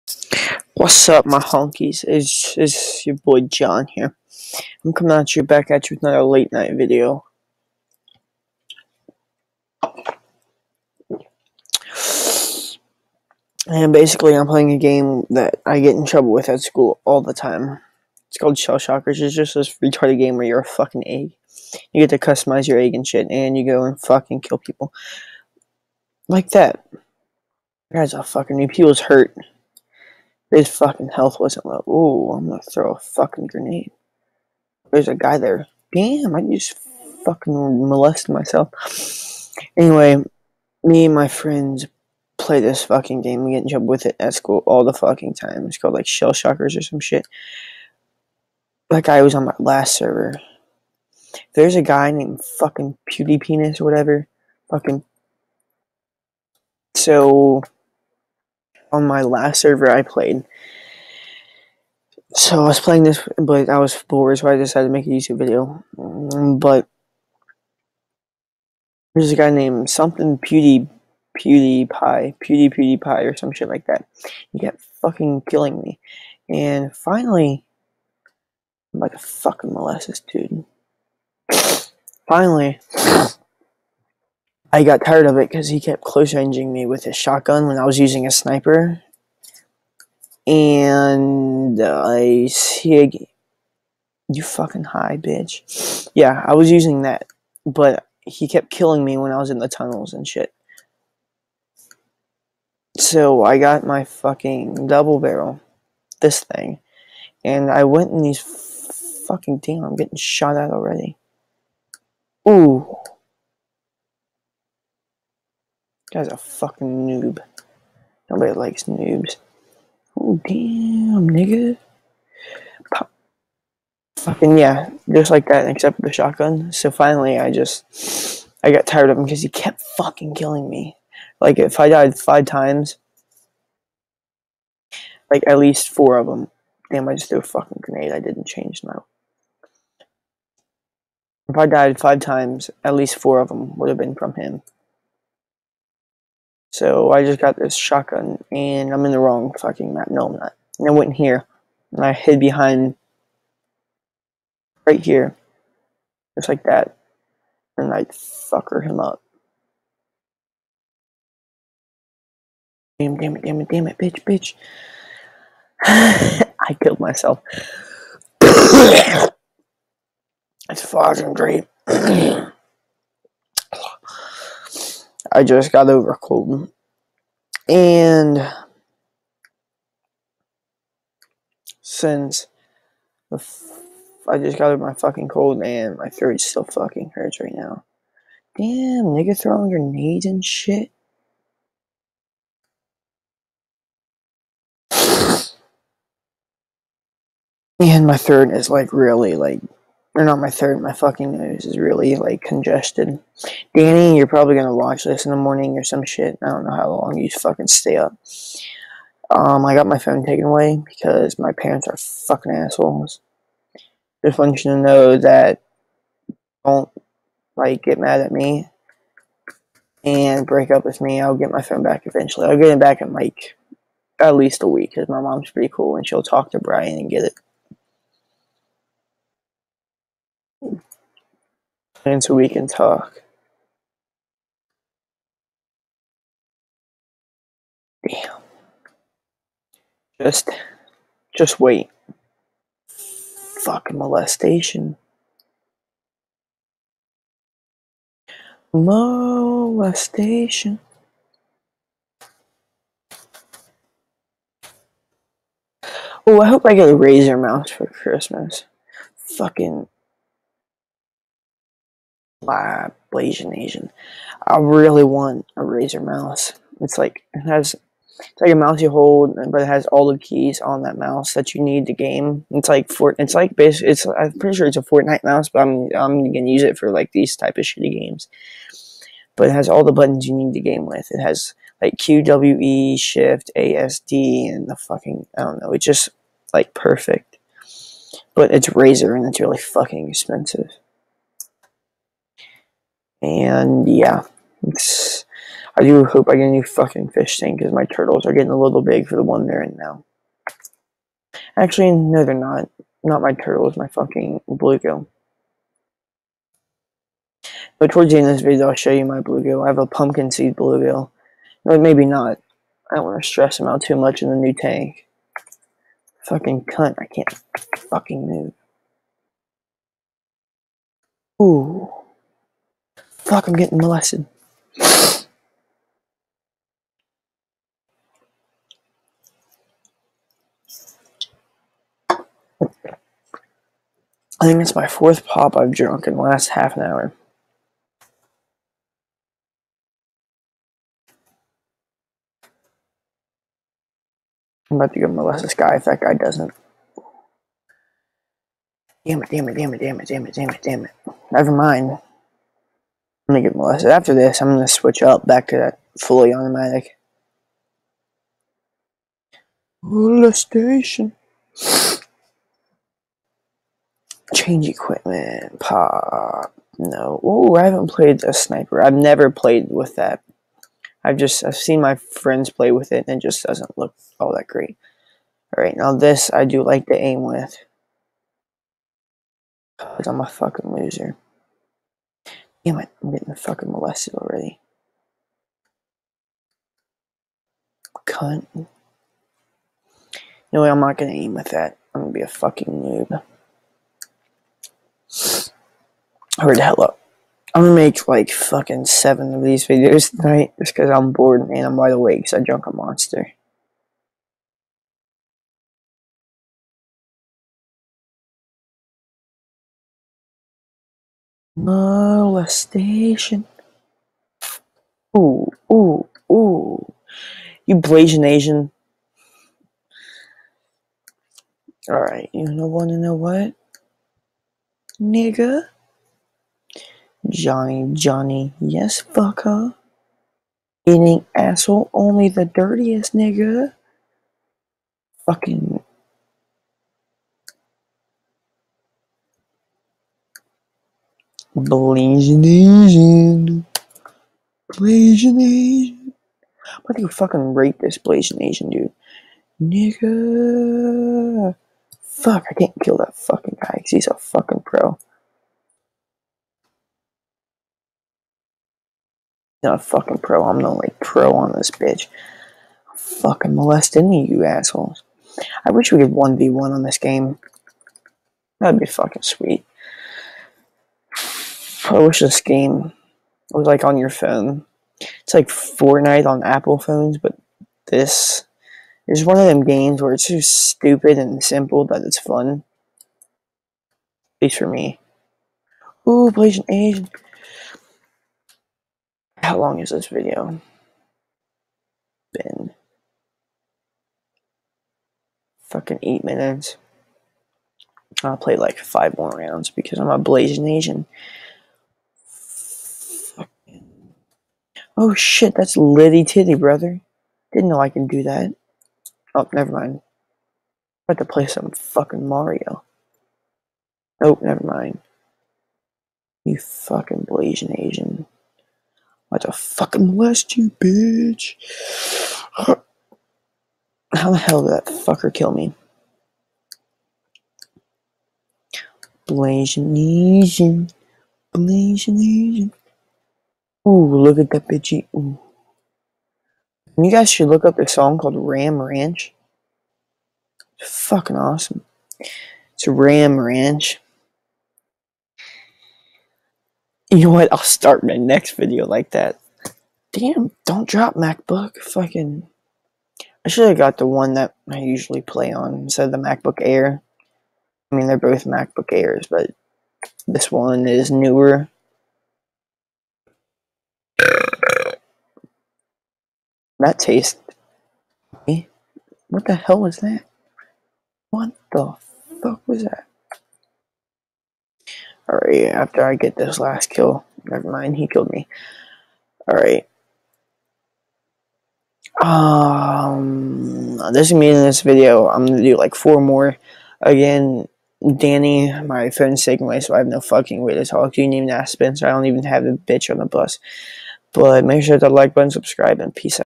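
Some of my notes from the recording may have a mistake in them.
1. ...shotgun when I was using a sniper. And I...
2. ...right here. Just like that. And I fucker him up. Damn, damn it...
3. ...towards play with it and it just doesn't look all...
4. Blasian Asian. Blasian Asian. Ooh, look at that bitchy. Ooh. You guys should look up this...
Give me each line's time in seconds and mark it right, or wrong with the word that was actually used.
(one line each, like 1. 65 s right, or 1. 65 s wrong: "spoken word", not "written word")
1. 87 s right
2. 154 s right
3. 371 s wrong: "friends", not "towards"
4. 529 s right.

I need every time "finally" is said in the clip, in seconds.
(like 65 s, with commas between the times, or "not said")
76 s, 82 s, 126 s.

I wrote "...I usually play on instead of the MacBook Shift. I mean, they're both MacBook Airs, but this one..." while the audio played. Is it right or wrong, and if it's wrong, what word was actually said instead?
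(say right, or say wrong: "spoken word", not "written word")
wrong: "Air", not "Shift".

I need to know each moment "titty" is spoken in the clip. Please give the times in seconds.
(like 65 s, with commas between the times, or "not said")
506 s.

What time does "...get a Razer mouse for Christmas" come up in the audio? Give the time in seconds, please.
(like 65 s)
256 s.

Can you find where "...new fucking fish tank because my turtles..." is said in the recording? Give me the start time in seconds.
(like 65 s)
296 s.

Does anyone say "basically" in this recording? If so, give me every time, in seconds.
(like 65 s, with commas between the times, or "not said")
13 s, 273 s.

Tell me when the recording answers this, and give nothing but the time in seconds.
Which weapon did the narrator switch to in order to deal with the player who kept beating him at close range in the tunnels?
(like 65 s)
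104 s.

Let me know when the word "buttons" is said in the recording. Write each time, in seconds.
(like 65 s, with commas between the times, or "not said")
279 s, 595 s.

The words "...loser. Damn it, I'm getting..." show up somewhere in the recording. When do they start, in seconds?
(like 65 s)
380 s.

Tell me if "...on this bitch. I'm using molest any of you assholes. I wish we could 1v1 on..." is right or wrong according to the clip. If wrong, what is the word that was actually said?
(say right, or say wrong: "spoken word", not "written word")
wrong: "fucking", not "using".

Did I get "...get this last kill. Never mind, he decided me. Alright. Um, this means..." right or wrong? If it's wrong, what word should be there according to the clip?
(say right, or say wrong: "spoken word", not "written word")
wrong: "killed", not "decided".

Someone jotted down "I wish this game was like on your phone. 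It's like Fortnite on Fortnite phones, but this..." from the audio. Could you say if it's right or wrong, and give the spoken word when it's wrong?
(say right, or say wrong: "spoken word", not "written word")
wrong: "Apple", not "Fortnite".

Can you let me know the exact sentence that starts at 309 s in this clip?
I have a pumpkin seed bluegill.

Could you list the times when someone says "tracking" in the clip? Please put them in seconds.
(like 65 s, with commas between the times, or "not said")
not said.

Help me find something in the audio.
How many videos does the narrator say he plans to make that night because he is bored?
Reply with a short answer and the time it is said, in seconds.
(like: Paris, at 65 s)
7, at 398 s.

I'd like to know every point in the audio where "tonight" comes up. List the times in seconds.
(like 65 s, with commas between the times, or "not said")
400 s.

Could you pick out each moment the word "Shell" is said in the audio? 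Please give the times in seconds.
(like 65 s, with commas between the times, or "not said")
18 s, 46 s.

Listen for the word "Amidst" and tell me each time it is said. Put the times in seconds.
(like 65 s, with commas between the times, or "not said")
not said.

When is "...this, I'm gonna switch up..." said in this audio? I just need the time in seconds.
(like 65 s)
354 s.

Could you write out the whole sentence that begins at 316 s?
Fucking cunt, I can't fucking move.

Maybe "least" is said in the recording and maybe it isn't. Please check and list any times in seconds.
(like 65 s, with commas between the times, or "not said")
135 s, 142 s, 224 s, 484 s.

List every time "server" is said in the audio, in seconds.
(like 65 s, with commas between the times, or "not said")
49 s, 59 s.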